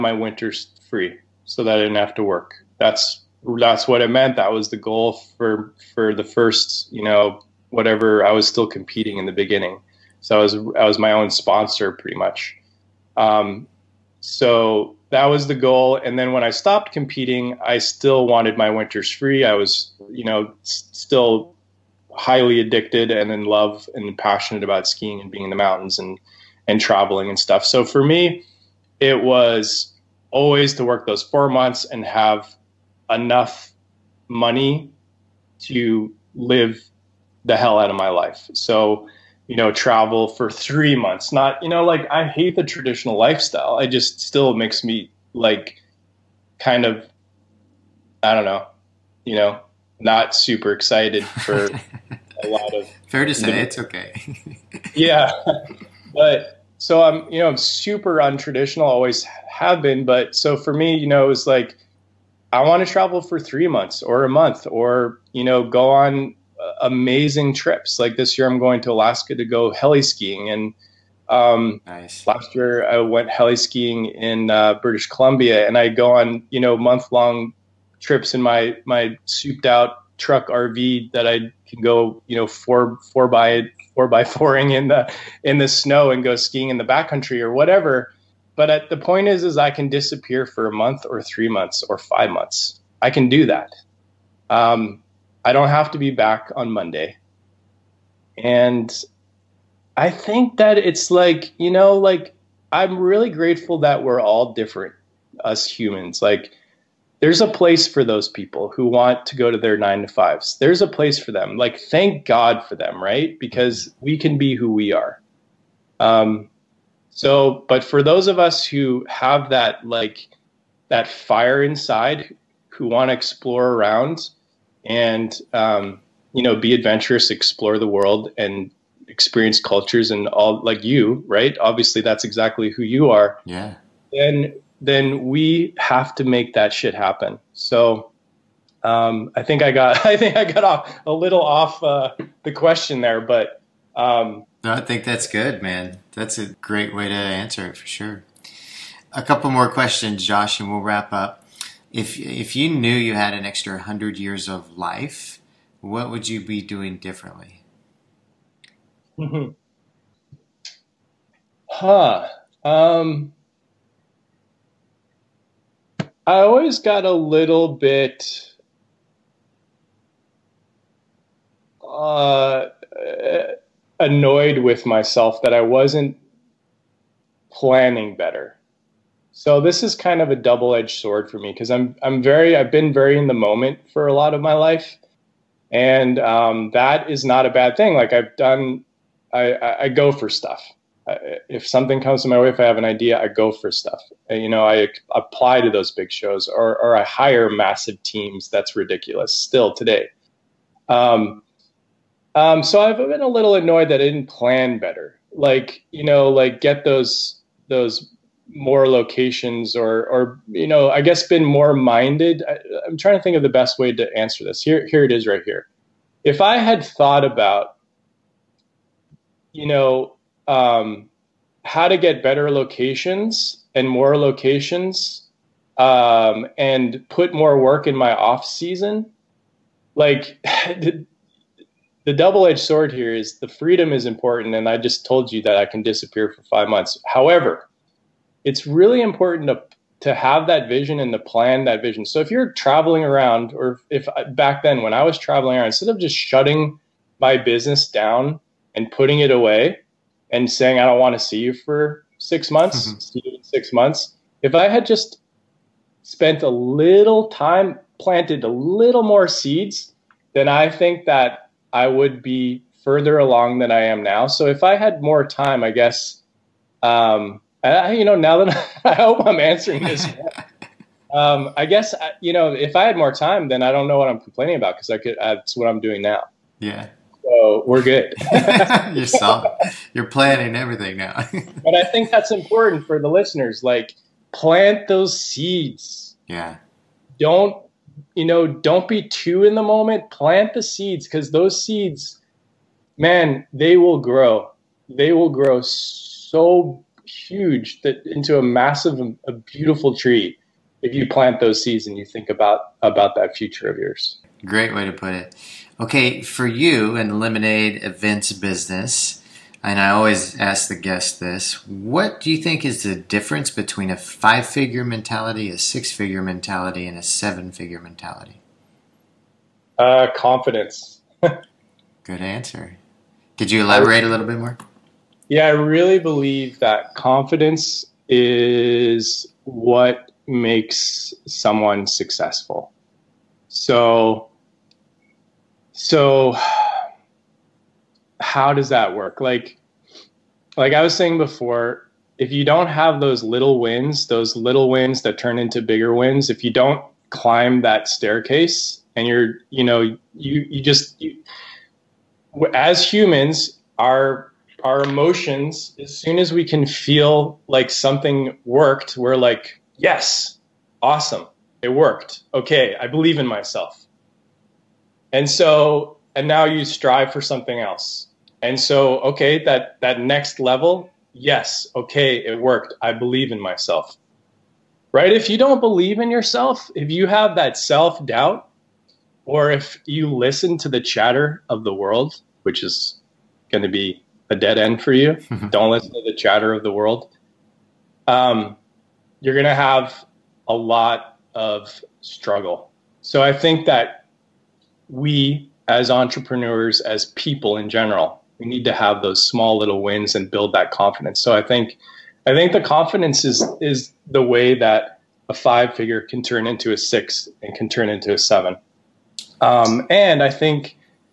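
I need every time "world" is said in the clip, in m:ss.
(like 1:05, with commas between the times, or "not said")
2:07, 6:21, 6:26.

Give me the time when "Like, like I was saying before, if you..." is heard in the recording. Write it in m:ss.
5:39.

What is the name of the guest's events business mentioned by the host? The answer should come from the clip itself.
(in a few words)
Lemonade Events.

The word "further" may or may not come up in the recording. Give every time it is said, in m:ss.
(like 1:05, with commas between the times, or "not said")
4:22.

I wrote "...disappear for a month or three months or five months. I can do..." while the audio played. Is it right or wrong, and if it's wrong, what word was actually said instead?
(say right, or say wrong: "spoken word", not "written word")
right.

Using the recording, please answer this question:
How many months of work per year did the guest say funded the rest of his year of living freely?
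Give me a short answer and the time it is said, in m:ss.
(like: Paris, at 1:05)
4, at 0:31.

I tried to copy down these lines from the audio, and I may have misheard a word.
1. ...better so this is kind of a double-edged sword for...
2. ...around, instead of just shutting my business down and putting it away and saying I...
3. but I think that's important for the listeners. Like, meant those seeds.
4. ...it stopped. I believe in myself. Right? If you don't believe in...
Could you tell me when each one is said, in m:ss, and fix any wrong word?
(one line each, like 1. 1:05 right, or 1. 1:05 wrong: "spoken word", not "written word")
1. 2:58 right
2. 4:05 right
3. 4:41 wrong: "plant", not "meant"
4. 6:12 wrong: "worked", not "stopped".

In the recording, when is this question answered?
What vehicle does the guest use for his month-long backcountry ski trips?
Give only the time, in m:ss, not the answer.
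1:20.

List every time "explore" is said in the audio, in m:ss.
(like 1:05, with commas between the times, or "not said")
2:03, 2:07.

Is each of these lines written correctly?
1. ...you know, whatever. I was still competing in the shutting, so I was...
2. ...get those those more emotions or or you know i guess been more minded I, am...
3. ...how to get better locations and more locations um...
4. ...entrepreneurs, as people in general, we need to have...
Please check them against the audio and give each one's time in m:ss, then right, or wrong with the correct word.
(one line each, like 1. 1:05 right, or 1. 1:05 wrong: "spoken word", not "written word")
1. 0:06 wrong: "beginning", not "shutting"
2. 3:26 wrong: "locations", not "emotions"
3. 3:41 right
4. 6:35 right.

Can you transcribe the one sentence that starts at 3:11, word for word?
I, if something comes to my way, if I have an idea, I go for stuff.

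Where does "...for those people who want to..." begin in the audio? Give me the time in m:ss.
1:47.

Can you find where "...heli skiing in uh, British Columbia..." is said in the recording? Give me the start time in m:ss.
1:13.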